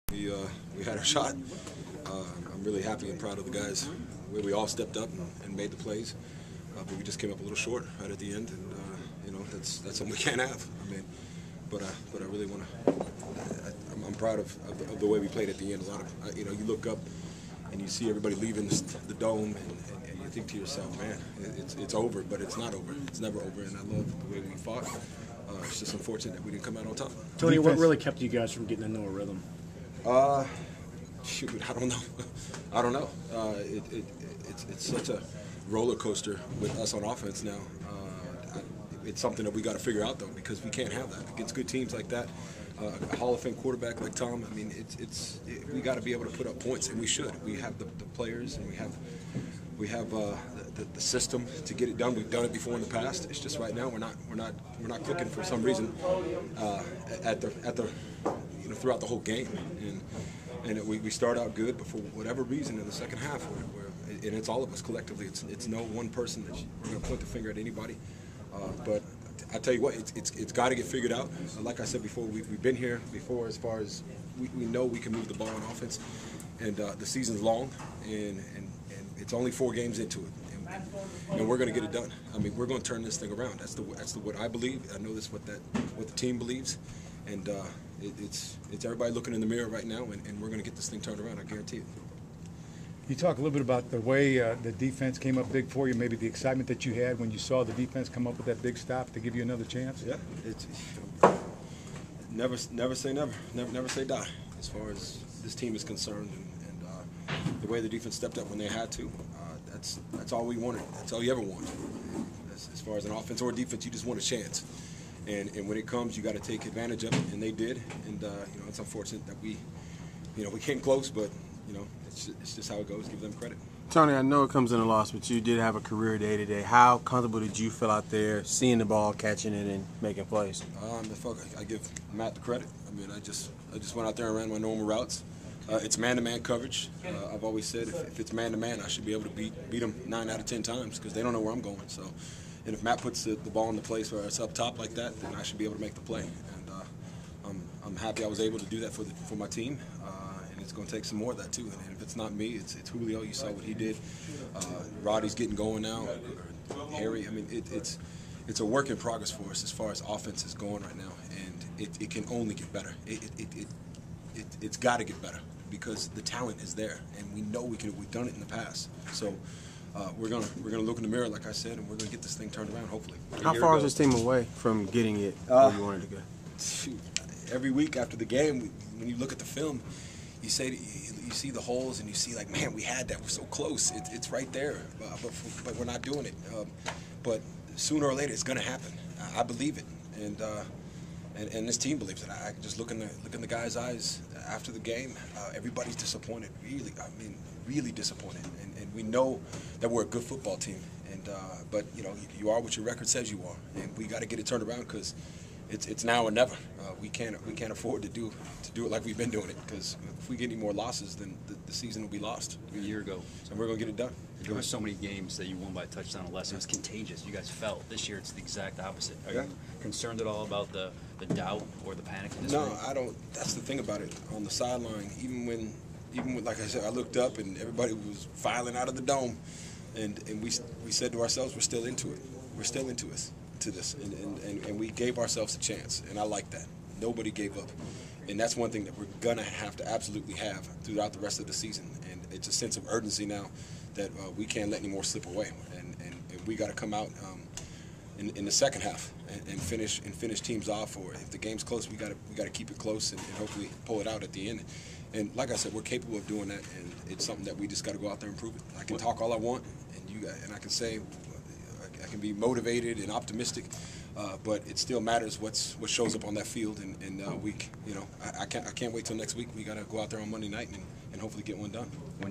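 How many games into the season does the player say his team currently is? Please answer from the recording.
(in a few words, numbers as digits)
4.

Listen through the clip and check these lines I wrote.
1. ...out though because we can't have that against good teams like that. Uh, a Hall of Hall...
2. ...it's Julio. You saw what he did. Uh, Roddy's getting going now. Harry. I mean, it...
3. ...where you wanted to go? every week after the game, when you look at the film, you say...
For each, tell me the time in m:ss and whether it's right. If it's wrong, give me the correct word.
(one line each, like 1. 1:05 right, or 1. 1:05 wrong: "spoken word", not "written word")
1. 0:40 wrong: "Fame", not "Hall"
2. 2:32 right
3. 2:55 right.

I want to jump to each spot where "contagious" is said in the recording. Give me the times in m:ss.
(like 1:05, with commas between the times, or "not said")
3:36.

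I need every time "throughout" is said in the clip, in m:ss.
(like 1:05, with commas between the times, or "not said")
0:58, 4:00.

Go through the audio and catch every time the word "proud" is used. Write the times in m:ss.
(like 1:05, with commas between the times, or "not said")
0:03, 0:14.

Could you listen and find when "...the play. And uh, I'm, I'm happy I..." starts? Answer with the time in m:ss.
2:25.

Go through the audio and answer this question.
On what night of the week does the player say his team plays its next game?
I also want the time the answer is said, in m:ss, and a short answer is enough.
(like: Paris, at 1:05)
Monday, at 4:30.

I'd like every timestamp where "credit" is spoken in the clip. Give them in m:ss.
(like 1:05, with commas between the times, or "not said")
2:03, 2:12.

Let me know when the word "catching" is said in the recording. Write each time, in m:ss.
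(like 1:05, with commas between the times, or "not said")
2:09.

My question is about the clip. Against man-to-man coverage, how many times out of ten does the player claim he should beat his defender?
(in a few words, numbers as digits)
9.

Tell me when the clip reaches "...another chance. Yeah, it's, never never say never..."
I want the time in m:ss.
1:39.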